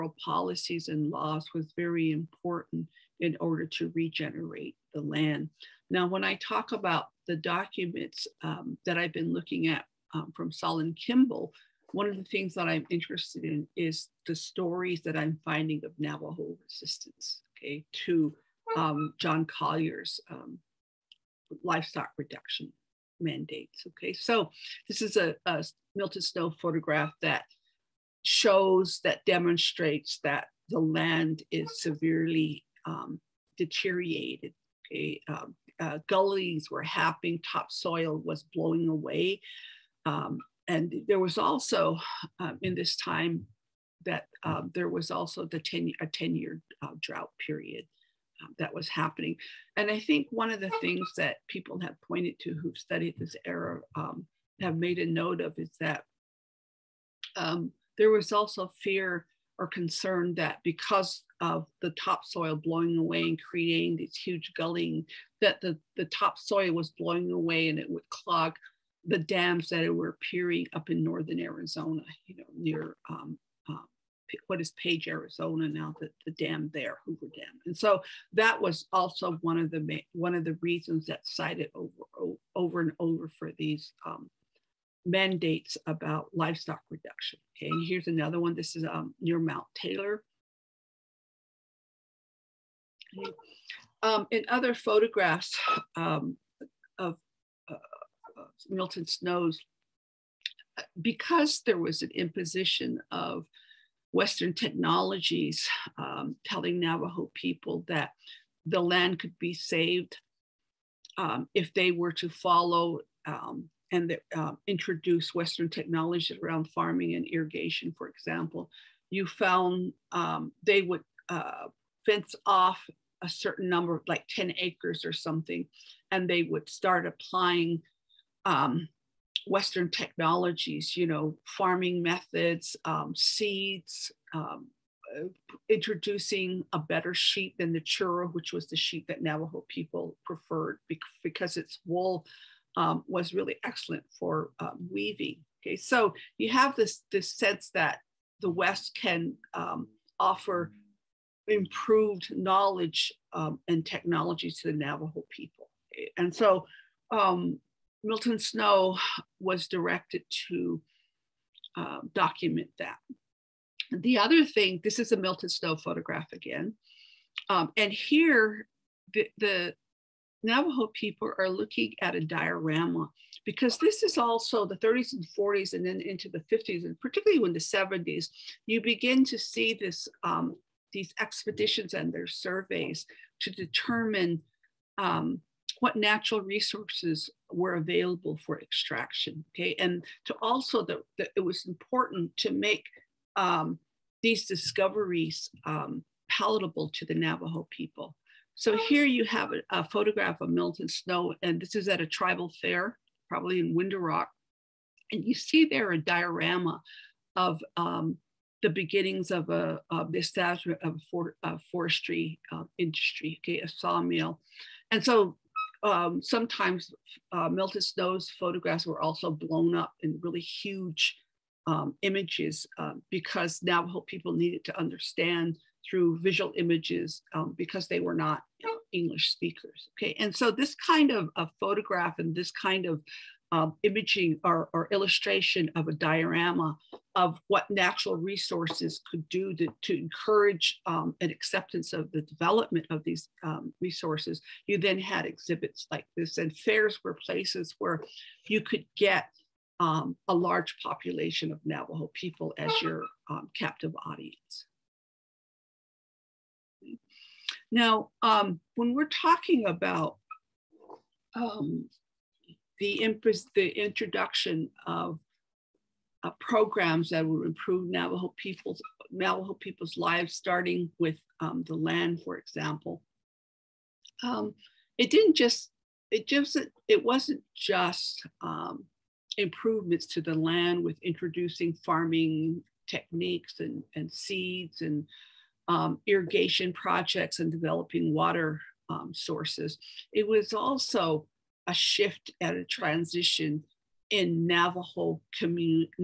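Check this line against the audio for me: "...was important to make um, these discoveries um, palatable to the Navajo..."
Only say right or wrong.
right.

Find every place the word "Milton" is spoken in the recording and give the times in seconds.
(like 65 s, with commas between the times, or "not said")
25 s, 98 s, 158 s, 165 s, 200 s, 217 s.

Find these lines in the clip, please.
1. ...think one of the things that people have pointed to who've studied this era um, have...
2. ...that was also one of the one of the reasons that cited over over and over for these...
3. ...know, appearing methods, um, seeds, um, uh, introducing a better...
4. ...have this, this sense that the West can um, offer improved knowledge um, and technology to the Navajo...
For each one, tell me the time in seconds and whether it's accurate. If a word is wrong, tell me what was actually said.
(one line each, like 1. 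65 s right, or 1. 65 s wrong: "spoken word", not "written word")
1. 49 s right
2. 78 s right
3. 131 s wrong: "farming", not "appearing"
4. 146 s right.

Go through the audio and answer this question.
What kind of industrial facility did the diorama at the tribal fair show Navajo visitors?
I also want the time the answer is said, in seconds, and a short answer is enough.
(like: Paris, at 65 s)
a sawmill, at 213 s.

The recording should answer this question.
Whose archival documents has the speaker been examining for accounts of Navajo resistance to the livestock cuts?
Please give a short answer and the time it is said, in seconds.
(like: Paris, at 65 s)
Solon Kimball, at 10 s.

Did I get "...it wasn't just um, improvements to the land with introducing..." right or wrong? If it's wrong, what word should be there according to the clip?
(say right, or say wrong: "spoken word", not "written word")
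right.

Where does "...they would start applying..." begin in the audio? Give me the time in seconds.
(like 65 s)
126 s.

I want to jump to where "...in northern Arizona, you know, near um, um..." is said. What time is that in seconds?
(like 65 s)
70 s.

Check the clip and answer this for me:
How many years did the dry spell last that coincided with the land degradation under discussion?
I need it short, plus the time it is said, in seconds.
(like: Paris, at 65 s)
10, at 46 s.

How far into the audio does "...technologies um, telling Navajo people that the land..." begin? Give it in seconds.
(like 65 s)
104 s.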